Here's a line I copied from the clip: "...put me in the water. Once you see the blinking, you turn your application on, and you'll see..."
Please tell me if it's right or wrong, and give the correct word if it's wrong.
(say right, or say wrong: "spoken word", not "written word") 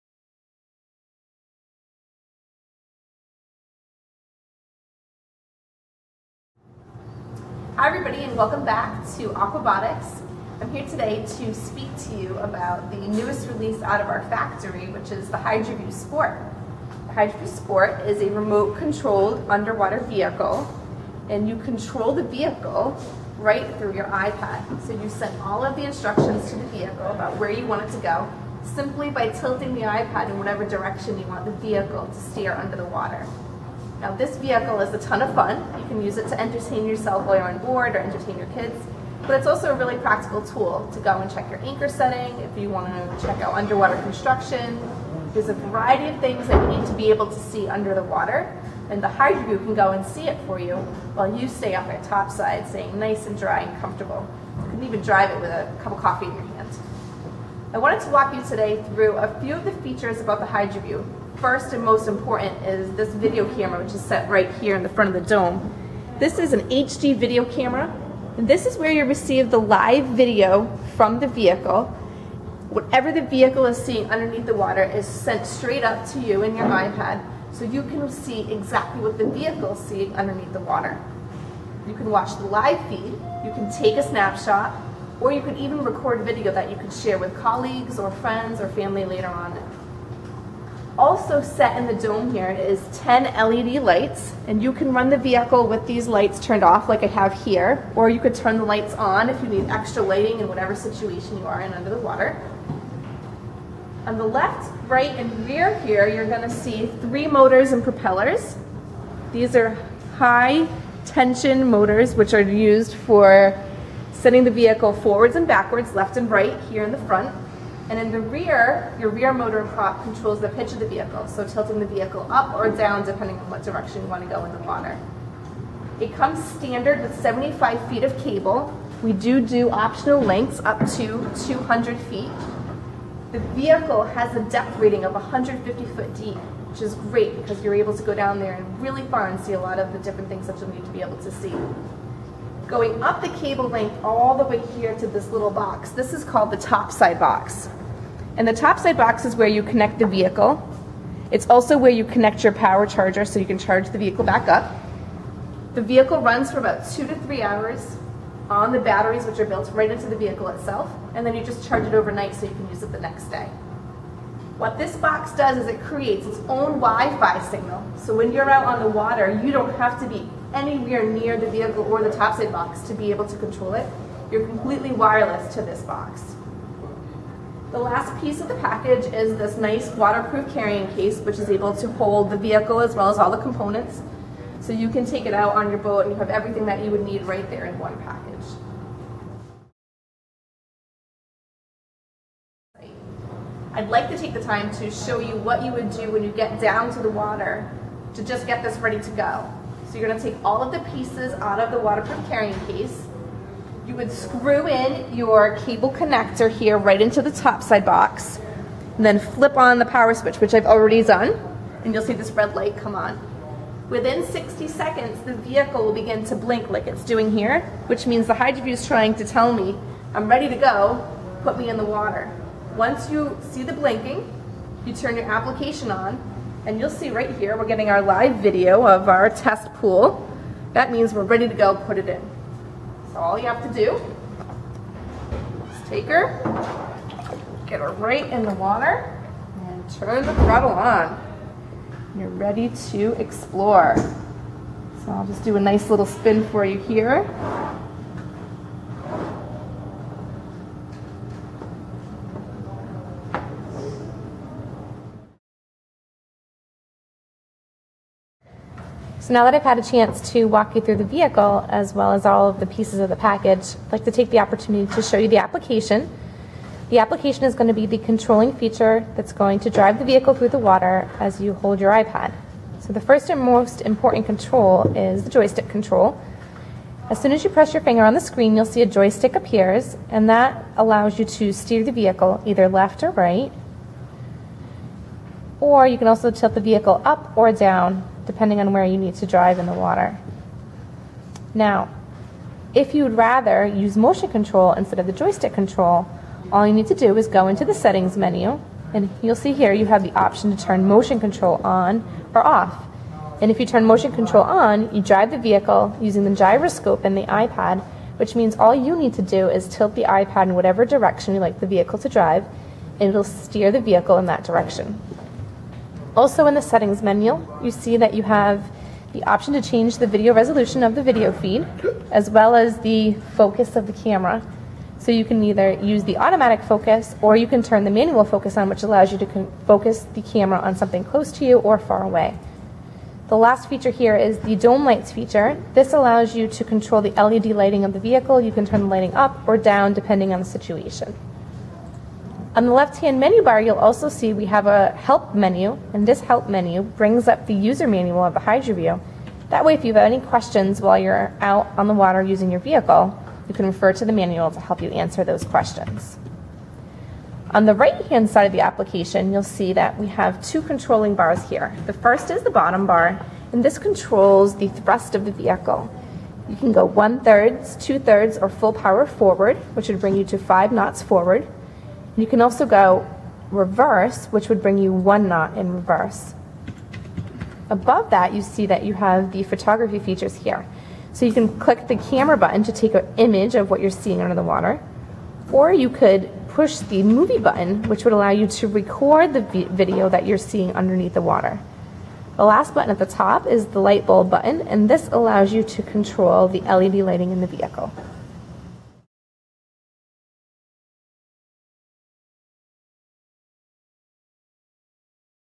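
right.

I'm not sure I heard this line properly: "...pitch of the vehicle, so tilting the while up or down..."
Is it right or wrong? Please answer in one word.
wrong.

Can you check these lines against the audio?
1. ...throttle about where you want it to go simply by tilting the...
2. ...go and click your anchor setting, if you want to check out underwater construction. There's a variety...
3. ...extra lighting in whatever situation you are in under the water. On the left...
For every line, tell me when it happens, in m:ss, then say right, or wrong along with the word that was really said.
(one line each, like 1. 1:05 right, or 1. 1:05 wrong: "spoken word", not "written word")
1. 0:26 wrong: "vehicle", not "throttle"
2. 0:41 wrong: "check", not "click"
3. 1:39 right.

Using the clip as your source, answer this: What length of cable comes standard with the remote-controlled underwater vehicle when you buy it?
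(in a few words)
75 feet.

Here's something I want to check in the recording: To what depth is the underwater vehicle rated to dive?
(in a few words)
150 feet.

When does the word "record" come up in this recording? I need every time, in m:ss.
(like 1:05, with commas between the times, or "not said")
1:25, 6:28.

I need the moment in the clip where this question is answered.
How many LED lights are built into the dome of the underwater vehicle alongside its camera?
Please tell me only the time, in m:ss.
1:32.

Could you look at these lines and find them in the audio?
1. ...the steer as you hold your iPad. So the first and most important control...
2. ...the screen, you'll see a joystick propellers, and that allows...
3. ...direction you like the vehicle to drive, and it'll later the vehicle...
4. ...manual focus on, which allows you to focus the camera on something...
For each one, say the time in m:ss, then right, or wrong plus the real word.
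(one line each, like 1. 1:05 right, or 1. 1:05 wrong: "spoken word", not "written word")
1. 4:30 wrong: "water", not "steer"
2. 4:38 wrong: "appears", not "propellers"
3. 5:10 wrong: "steer", not "later"
4. 5:27 right.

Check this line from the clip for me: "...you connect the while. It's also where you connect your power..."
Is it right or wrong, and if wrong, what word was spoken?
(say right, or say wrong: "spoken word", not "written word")
wrong: "vehicle", not "while".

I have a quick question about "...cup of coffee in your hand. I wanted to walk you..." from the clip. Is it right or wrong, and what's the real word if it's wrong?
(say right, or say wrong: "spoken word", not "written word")
right.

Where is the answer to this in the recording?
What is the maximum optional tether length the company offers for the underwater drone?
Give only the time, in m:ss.
2:11.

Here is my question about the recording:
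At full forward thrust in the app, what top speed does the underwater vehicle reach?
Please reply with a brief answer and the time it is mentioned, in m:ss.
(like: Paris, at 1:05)
5 knots, at 6:10.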